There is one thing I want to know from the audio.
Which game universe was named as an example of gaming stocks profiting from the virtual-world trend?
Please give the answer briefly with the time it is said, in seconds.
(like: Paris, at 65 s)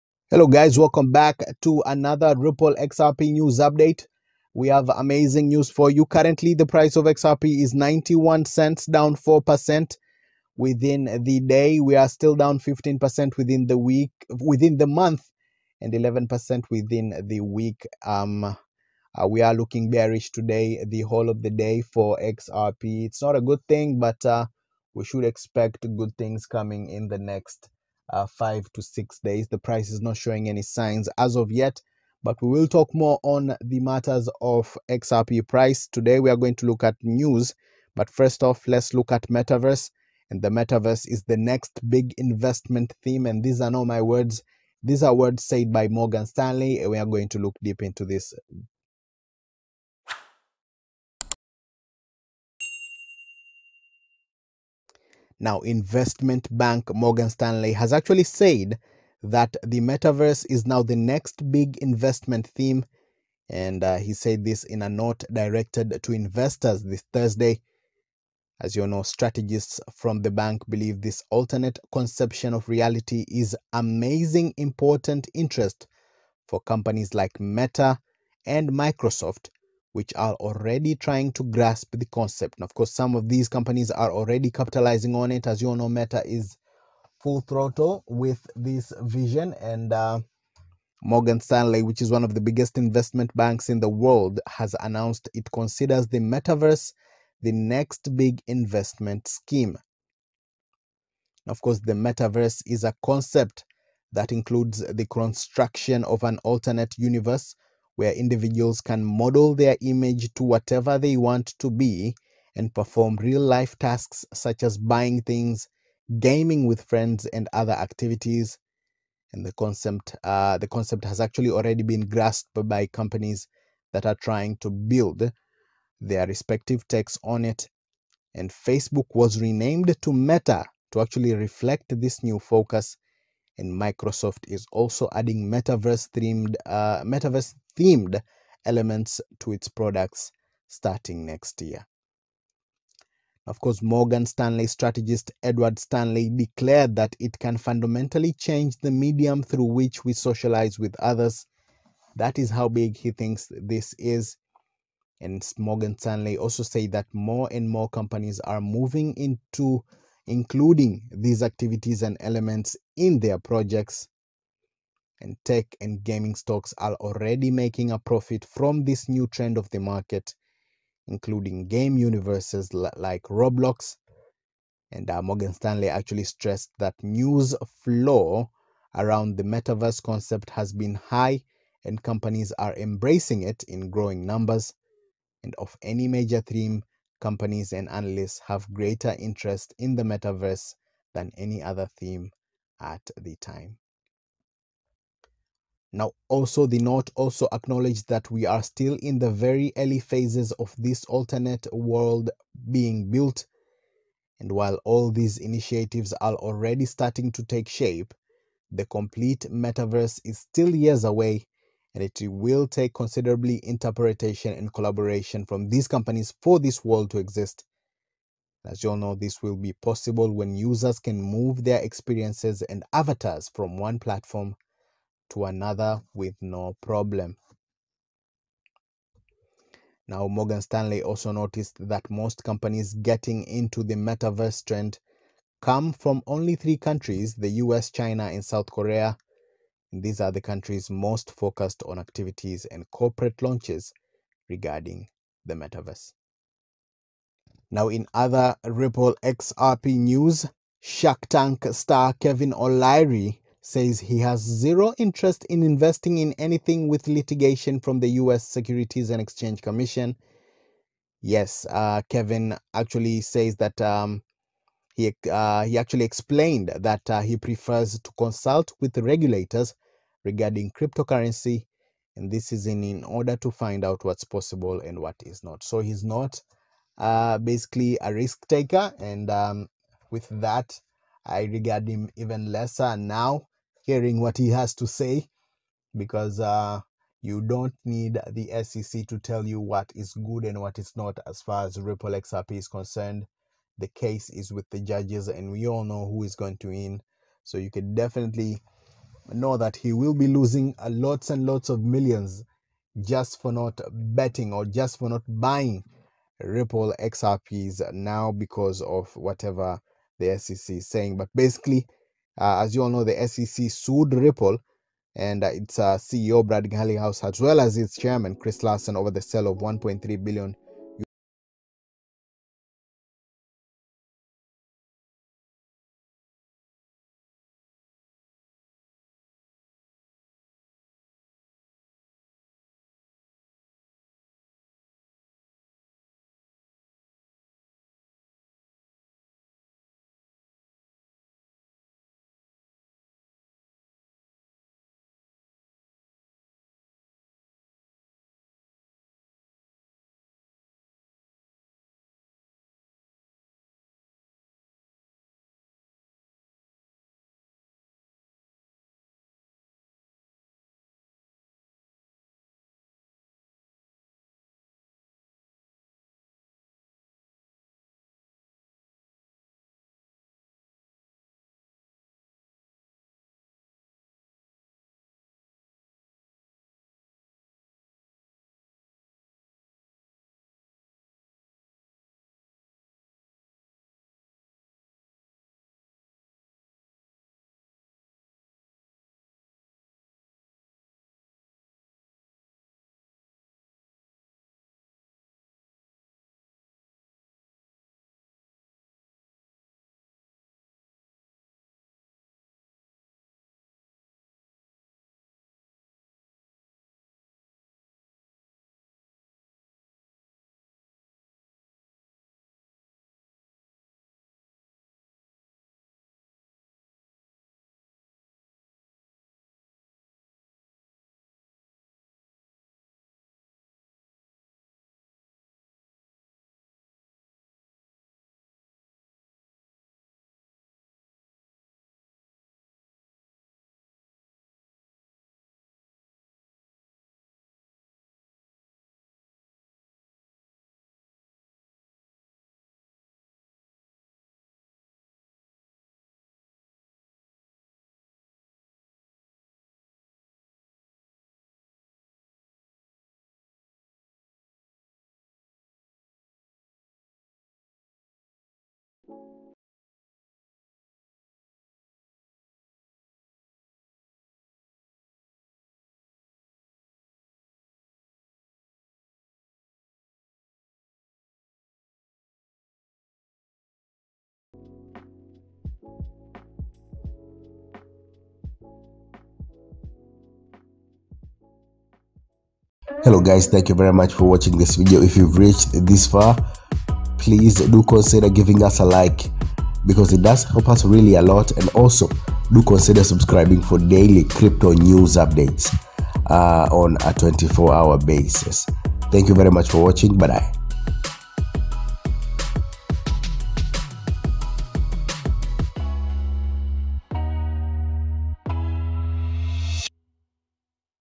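Roblox, at 173 s.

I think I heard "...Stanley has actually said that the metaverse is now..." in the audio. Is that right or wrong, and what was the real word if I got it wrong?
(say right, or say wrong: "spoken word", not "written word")
right.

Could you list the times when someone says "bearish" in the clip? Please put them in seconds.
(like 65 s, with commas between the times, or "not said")
19 s.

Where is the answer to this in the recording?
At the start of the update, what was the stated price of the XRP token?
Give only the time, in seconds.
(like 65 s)
7 s.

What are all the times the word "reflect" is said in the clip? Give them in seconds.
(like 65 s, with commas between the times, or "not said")
131 s.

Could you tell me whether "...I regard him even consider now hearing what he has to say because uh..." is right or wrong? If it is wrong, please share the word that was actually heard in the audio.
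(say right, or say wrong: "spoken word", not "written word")
wrong: "lesser", not "consider".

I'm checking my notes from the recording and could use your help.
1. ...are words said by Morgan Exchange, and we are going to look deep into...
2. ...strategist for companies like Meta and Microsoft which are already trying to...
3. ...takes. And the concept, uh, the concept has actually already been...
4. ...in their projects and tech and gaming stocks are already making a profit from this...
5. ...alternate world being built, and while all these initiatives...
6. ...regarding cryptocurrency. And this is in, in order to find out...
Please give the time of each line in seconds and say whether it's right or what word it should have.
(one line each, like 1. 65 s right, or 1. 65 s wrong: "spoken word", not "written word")
1. 45 s wrong: "Stanley", not "Exchange"
2. 75 s wrong: "interest", not "strategist"
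3. 117 s wrong: "activities", not "takes"
4. 162 s right
5. 201 s right
6. 270 s right.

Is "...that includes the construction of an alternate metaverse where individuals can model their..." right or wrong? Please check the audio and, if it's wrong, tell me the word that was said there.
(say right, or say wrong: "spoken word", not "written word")
wrong: "universe", not "metaverse".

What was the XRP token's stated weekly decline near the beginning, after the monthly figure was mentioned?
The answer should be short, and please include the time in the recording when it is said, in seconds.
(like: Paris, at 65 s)
11%, at 15 s.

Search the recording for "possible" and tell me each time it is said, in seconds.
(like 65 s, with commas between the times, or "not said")
219 s, 274 s.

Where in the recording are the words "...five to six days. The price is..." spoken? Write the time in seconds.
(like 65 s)
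28 s.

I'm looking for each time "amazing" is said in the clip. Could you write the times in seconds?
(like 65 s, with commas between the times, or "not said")
4 s, 73 s.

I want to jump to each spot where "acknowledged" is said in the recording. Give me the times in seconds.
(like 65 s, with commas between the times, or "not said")
197 s.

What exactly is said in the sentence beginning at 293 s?
The case is with the judges, and we all know who is going to win.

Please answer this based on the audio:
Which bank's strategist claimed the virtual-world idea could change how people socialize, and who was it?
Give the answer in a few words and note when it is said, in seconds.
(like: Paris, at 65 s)
Edward Stanley, at 145 s.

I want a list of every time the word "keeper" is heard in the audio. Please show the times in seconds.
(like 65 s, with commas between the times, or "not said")
not said.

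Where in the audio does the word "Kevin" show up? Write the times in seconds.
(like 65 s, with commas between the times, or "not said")
252 s, 262 s.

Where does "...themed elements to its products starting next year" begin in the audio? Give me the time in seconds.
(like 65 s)
137 s.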